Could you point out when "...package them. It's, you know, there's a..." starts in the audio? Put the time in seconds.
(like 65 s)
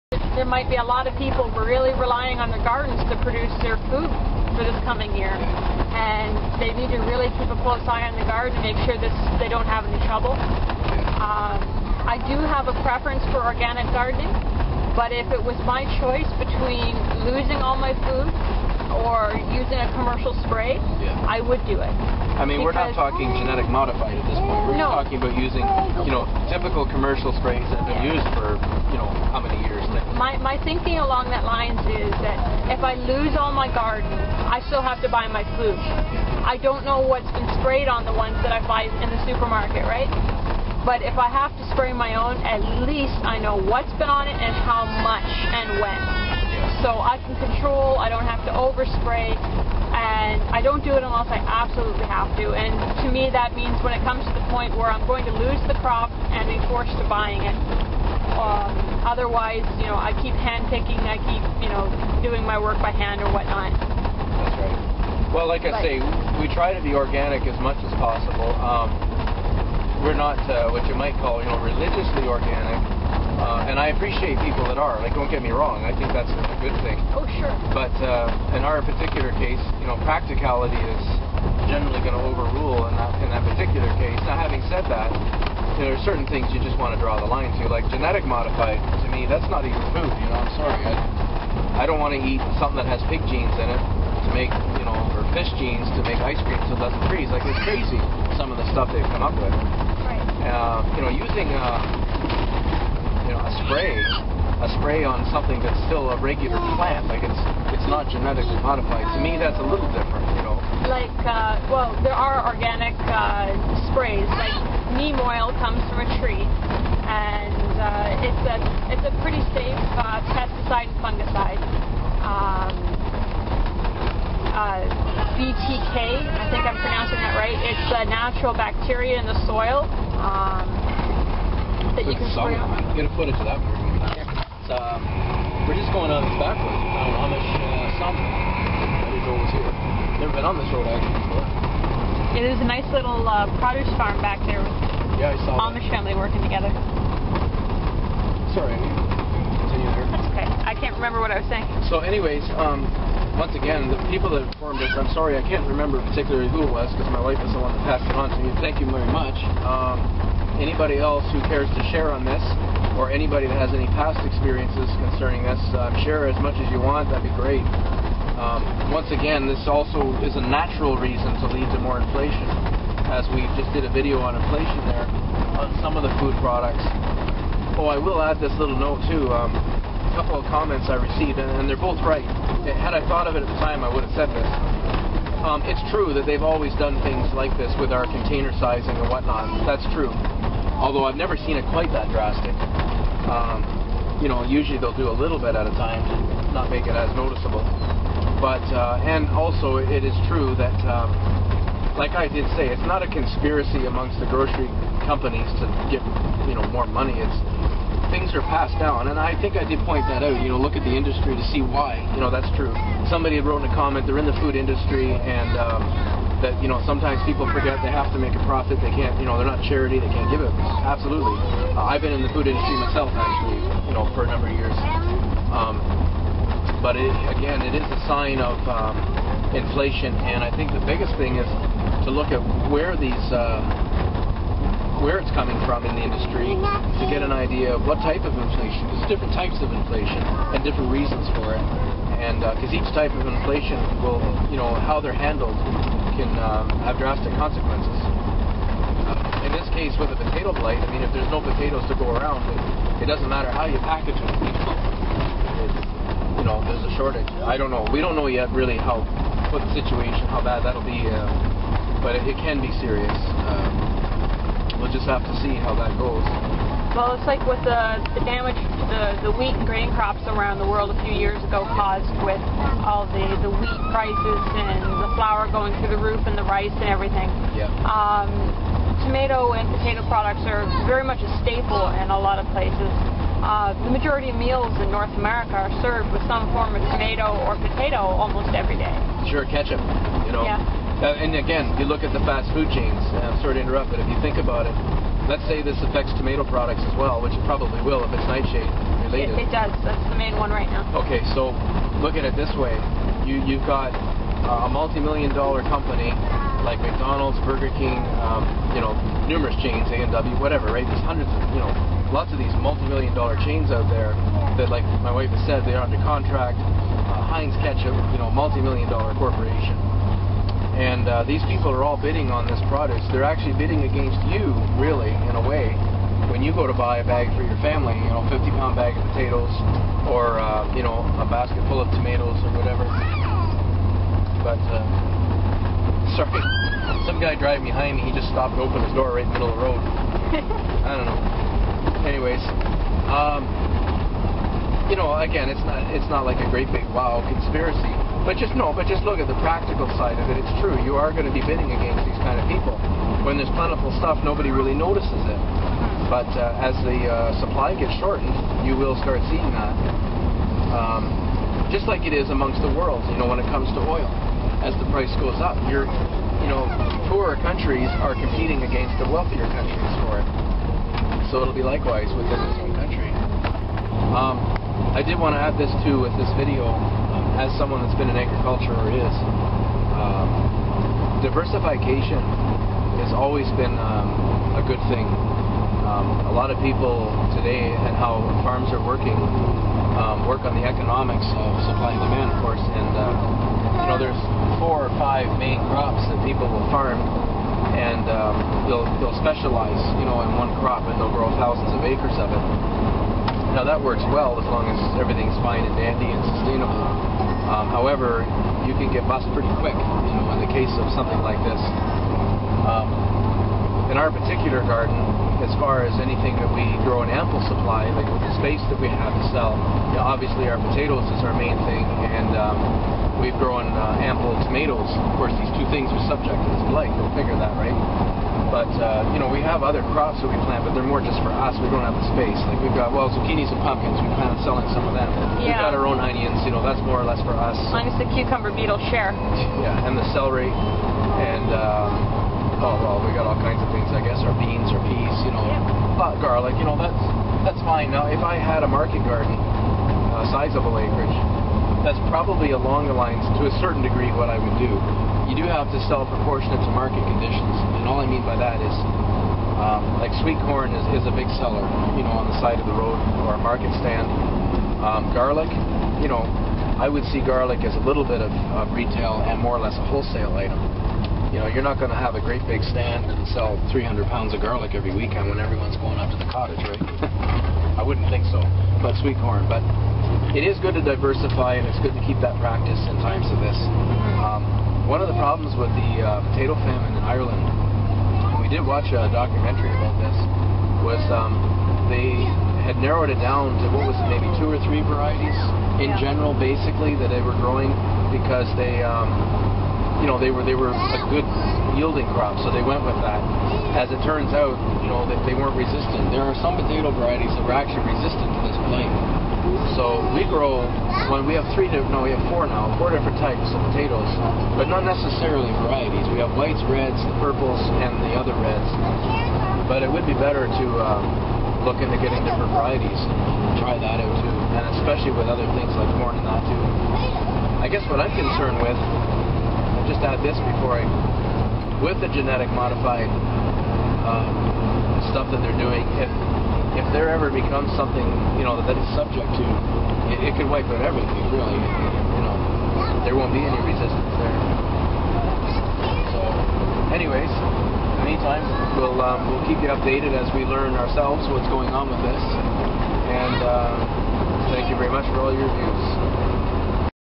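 253 s.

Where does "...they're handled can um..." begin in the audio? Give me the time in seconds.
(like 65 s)
245 s.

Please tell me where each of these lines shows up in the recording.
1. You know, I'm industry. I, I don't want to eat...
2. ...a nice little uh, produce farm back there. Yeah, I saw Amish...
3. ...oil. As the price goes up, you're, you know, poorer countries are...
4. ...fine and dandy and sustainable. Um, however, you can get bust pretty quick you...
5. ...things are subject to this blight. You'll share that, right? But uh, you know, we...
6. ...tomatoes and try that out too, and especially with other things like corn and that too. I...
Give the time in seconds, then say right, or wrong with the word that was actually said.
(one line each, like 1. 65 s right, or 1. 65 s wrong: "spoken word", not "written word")
1. 90 s wrong: "sorry", not "industry"
2. 142 s right
3. 363 s right
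4. 405 s right
5. 425 s wrong: "figure", not "share"
6. 522 s wrong: "varieties", not "tomatoes".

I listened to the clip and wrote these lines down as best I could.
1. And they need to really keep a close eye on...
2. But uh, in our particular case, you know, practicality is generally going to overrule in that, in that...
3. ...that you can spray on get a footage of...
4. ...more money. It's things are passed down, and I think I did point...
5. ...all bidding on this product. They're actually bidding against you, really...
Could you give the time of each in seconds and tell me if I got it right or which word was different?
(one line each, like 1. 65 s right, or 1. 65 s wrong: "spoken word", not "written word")
1. 5 s right
2. 77 s right
3. 131 s right
4. 206 s right
5. 321 s right.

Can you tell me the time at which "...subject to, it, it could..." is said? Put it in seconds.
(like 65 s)
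538 s.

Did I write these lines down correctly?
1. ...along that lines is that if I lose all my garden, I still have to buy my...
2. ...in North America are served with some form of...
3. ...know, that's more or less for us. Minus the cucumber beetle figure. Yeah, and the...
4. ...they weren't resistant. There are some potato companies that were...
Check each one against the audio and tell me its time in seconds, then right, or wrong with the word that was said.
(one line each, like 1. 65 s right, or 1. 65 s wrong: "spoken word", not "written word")
1. 31 s right
2. 284 s right
3. 436 s wrong: "share", not "figure"
4. 505 s wrong: "varieties", not "companies".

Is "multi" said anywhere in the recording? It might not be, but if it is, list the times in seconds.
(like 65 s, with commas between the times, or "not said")
304 s, 312 s, 318 s.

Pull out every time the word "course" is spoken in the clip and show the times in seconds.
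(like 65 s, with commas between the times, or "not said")
392 s, 425 s.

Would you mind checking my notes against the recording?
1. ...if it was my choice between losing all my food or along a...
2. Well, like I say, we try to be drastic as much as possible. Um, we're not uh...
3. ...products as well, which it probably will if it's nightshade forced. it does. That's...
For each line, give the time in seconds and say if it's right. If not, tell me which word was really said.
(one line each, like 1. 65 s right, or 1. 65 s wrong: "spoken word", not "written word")
1. 15 s wrong: "using", not "along"
2. 65 s wrong: "organic", not "drastic"
3. 296 s wrong: "related", not "forced".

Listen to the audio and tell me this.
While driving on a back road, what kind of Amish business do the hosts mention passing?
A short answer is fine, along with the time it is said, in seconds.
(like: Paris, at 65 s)
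Sawmill, at 138 s.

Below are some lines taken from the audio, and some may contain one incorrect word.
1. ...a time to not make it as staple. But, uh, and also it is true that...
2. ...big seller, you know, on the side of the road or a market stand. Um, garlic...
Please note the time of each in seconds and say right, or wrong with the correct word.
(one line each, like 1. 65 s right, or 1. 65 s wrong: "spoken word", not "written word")
1. 195 s wrong: "noticeable", not "staple"
2. 461 s right.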